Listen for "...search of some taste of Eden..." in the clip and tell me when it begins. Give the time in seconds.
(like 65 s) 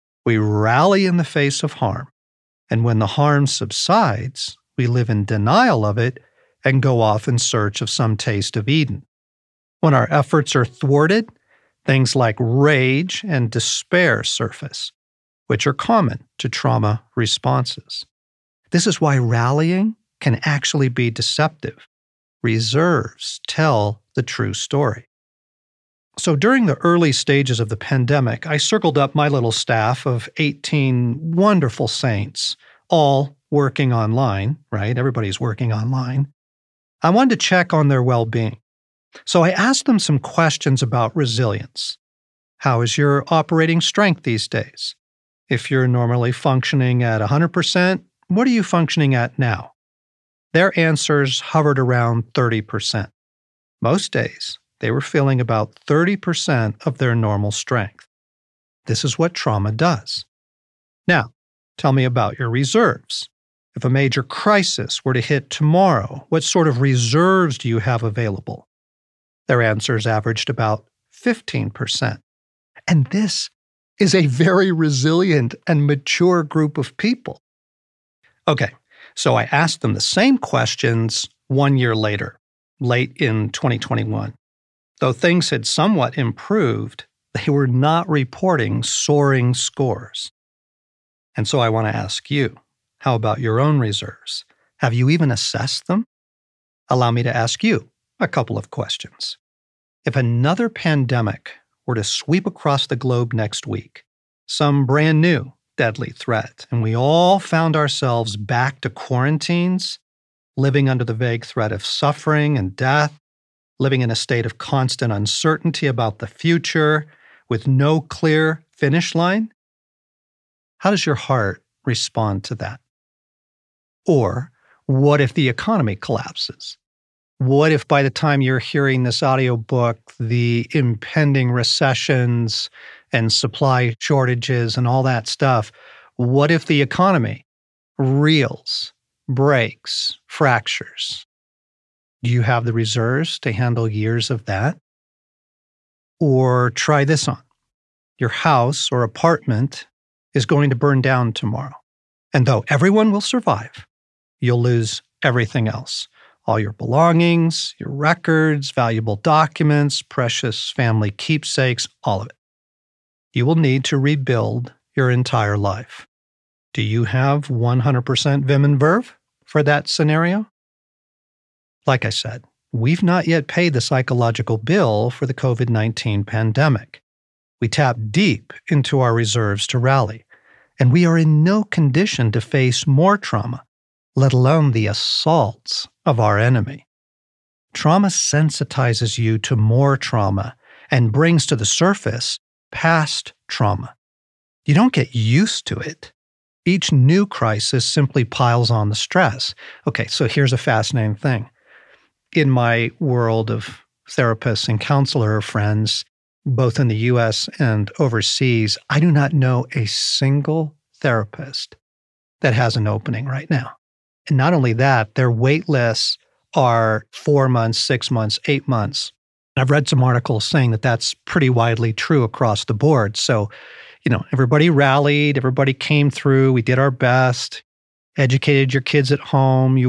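7 s.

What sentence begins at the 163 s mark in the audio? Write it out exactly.
You will need to rebuild your entire life.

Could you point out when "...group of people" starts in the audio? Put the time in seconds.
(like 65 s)
76 s.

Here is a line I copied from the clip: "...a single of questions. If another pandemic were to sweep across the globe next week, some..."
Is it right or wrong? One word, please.
wrong.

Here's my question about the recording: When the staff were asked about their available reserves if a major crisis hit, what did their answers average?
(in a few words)
15%.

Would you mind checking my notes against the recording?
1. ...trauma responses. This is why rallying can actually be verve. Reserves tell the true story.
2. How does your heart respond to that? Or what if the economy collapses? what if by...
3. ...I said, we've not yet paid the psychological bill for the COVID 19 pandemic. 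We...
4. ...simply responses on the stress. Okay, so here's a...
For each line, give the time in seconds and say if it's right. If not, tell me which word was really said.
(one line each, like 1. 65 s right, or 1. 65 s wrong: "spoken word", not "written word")
1. 16 s wrong: "deceptive", not "verve"
2. 120 s right
3. 172 s right
4. 197 s wrong: "piles", not "responses".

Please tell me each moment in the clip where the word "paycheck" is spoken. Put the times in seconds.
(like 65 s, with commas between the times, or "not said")
not said.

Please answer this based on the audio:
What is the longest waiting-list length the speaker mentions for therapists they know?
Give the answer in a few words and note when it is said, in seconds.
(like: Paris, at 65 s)
8 months, at 218 s.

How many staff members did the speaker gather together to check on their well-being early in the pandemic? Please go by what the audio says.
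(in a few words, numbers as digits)
18.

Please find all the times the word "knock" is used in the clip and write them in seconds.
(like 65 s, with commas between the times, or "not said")
not said.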